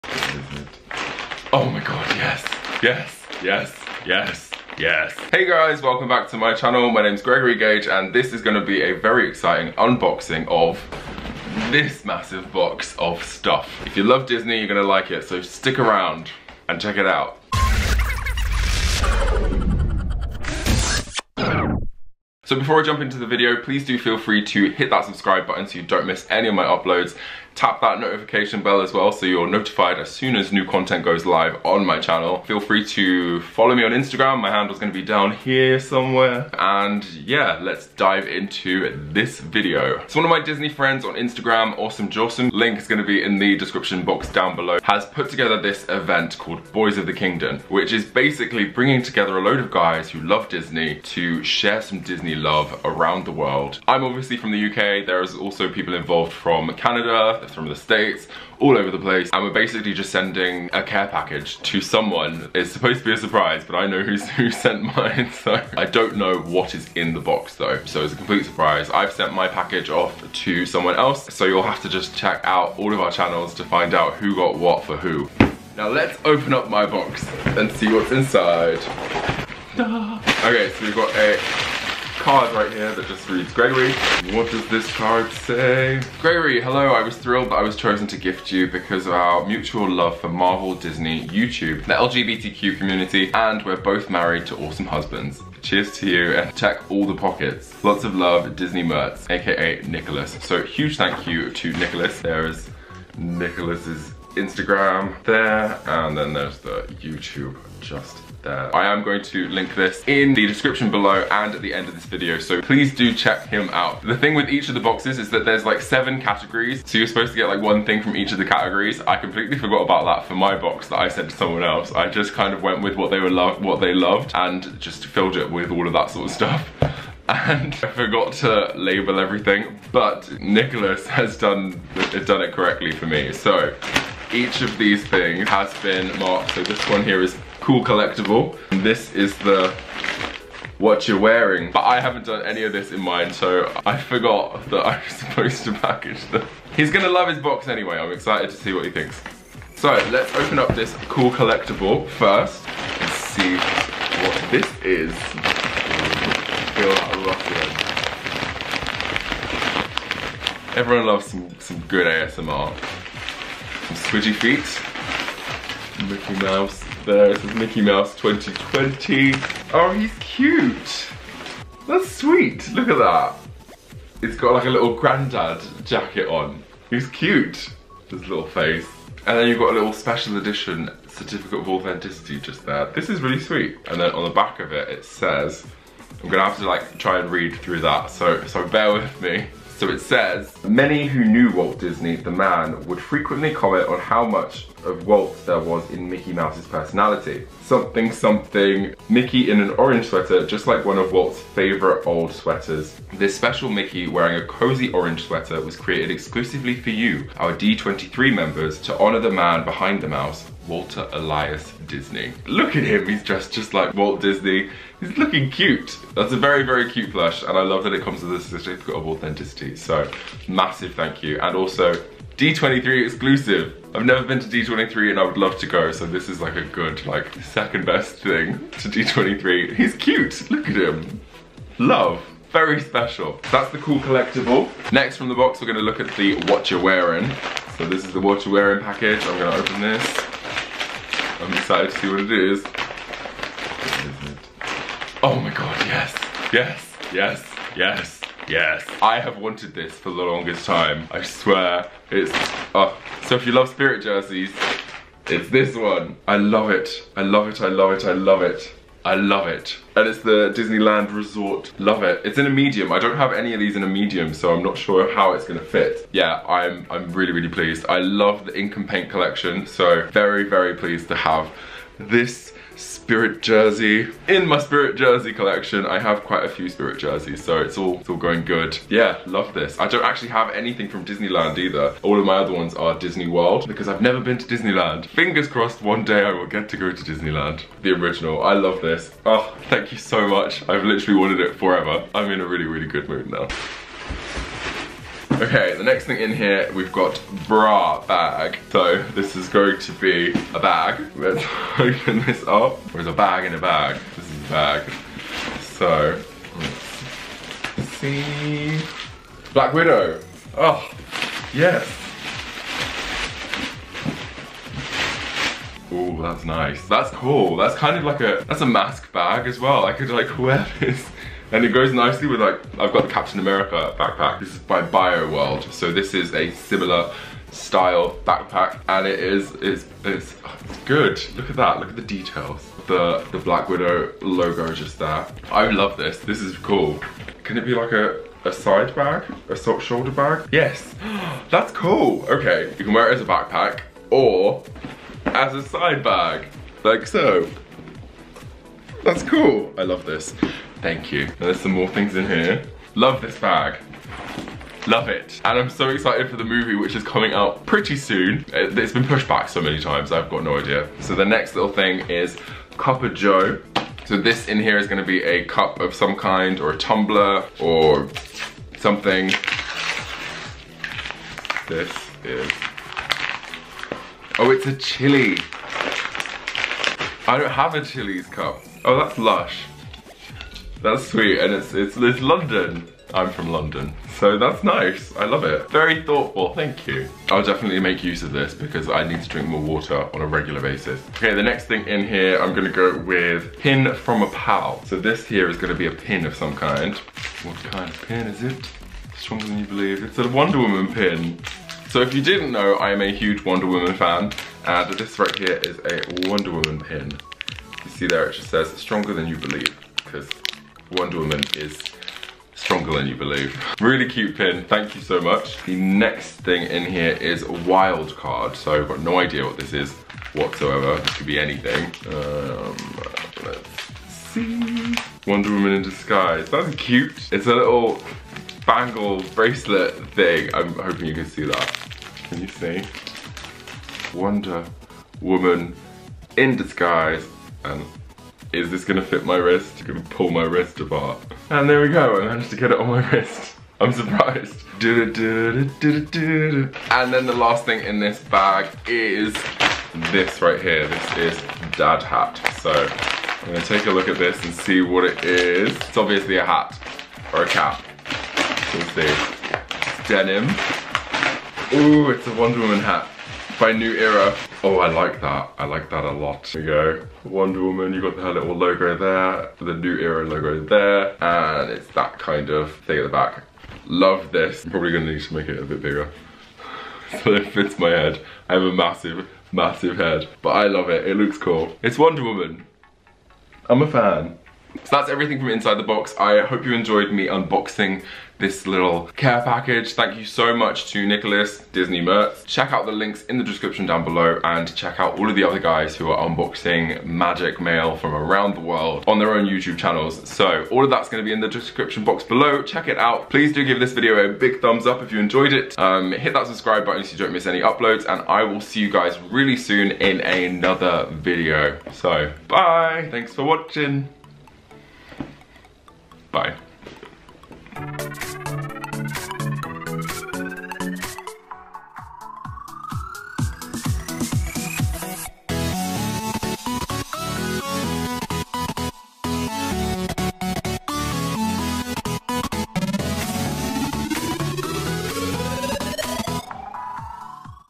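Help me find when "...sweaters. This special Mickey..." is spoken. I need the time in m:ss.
3:22.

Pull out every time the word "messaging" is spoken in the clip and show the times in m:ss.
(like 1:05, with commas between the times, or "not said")
not said.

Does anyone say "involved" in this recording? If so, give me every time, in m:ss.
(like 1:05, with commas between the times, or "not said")
0:55.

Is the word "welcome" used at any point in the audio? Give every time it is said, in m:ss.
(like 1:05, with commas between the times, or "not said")
0:05.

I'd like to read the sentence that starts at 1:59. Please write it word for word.
I completely forgot about that for my box that I sent to someone else.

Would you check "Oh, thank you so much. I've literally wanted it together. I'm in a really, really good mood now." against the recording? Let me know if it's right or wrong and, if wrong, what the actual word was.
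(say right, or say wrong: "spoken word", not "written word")
wrong: "forever", not "together".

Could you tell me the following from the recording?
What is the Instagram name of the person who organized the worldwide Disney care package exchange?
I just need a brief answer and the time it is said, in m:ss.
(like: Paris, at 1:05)
Awesome Jasem, at 0:41.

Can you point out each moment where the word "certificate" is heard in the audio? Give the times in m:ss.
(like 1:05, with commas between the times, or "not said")
3:01, 3:38.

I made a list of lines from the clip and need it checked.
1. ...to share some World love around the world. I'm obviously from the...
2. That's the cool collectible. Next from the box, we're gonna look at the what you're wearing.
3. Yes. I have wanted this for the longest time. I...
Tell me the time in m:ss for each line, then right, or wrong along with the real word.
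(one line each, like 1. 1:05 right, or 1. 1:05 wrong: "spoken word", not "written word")
1. 0:51 wrong: "Disney", not "World"
2. 3:53 right
3. 4:08 right.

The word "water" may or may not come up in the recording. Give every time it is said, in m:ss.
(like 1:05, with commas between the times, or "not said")
6:29.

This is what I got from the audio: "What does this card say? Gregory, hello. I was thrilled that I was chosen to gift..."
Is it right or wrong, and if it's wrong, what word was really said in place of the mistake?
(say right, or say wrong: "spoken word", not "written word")
right.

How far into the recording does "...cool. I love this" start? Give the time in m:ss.
5:49.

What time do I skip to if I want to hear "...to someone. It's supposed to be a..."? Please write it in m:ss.
1:01.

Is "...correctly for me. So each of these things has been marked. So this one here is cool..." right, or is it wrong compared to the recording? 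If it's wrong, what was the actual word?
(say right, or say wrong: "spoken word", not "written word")
right.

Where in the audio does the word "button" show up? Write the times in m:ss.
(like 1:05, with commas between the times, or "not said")
0:25, 8:26.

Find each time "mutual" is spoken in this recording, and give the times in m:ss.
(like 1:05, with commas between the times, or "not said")
1:29.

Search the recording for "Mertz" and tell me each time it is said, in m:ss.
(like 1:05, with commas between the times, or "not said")
1:38, 8:12.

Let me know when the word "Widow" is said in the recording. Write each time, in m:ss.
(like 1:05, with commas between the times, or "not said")
5:09, 5:33.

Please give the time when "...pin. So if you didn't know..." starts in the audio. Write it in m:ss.
6:40.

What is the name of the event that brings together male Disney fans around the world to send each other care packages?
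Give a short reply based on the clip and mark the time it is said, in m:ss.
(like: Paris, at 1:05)
Boys of the Kingdom, at 0:46.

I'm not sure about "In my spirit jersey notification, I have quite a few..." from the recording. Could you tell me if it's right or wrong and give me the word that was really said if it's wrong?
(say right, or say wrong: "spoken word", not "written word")
wrong: "collection", not "notification".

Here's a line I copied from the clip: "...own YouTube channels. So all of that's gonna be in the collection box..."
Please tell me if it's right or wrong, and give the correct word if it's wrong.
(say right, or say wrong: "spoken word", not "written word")
wrong: "description", not "collection".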